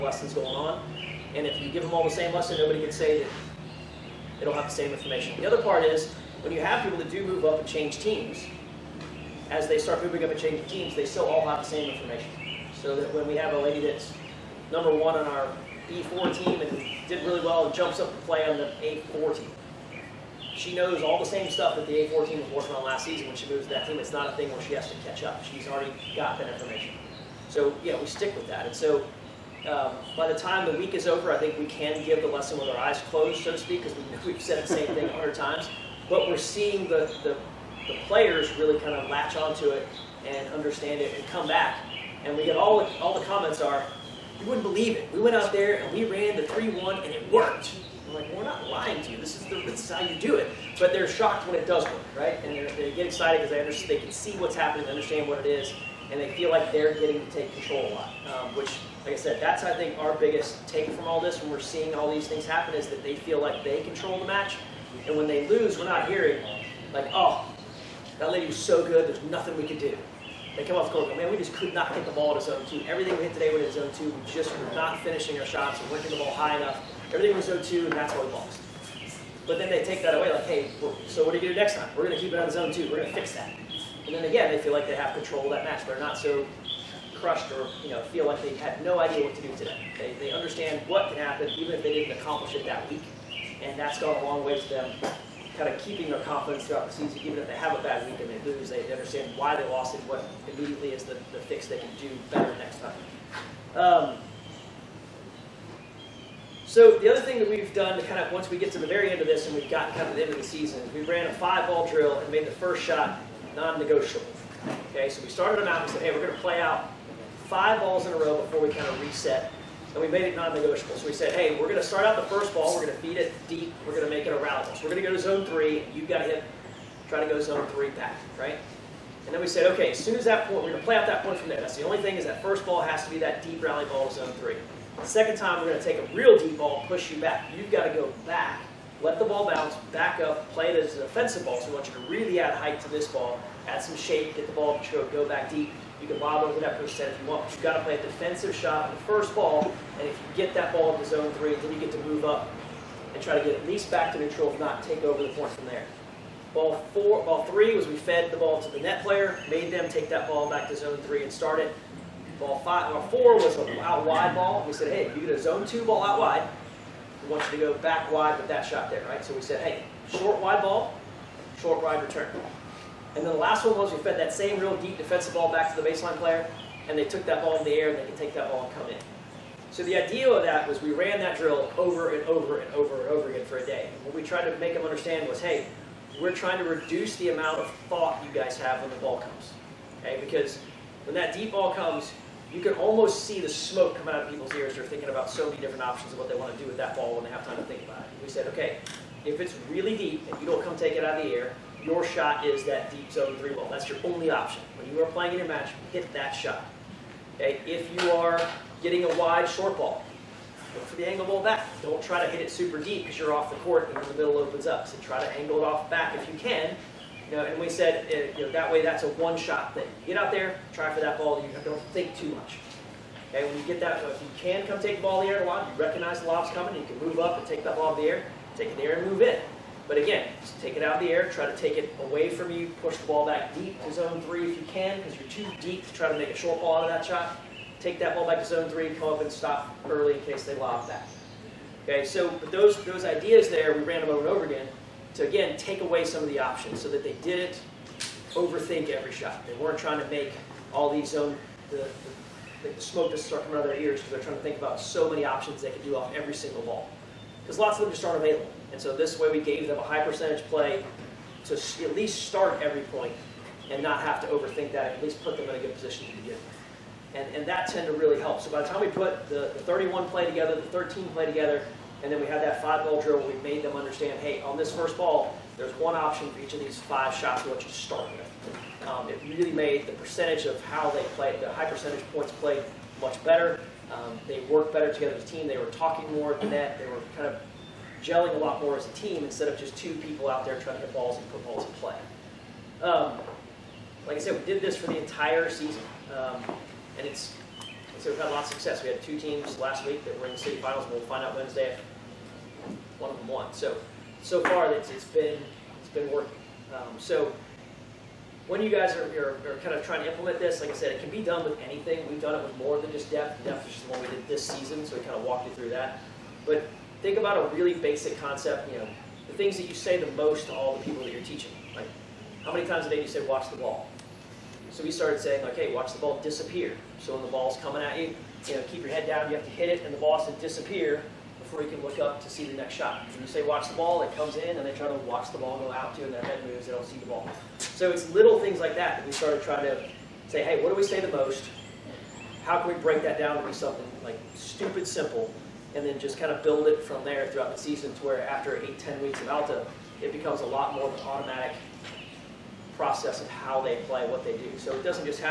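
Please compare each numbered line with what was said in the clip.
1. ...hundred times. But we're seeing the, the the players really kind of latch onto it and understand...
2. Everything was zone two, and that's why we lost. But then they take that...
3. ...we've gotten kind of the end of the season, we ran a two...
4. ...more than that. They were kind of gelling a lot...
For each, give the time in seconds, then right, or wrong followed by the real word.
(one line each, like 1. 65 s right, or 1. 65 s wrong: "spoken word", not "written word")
1. 35 s right
2. 77 s right
3. 109 s wrong: "five", not "two"
4. 286 s right.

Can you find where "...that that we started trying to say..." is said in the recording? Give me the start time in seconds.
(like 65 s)
338 s.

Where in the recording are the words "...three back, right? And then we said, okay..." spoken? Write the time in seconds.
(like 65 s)
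127 s.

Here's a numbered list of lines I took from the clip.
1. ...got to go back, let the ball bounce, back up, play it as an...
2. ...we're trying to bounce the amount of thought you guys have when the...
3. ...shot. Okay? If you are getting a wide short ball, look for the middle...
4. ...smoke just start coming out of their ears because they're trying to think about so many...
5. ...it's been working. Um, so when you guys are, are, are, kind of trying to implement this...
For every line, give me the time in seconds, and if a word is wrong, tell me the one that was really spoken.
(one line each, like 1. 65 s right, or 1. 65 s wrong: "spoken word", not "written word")
1. 137 s right
2. 186 s wrong: "reduce", not "bounce"
3. 206 s wrong: "angle", not "middle"
4. 252 s right
5. 305 s right.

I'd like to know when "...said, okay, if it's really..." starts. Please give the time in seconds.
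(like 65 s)
198 s.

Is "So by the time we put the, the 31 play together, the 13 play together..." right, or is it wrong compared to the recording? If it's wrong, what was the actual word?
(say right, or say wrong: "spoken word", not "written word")
right.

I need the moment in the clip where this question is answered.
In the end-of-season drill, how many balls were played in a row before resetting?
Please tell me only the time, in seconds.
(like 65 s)
117 s.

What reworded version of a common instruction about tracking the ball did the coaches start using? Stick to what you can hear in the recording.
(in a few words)
Watch the ball disappear.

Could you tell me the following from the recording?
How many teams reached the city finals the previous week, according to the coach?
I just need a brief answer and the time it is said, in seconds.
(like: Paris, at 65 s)
2, at 299 s.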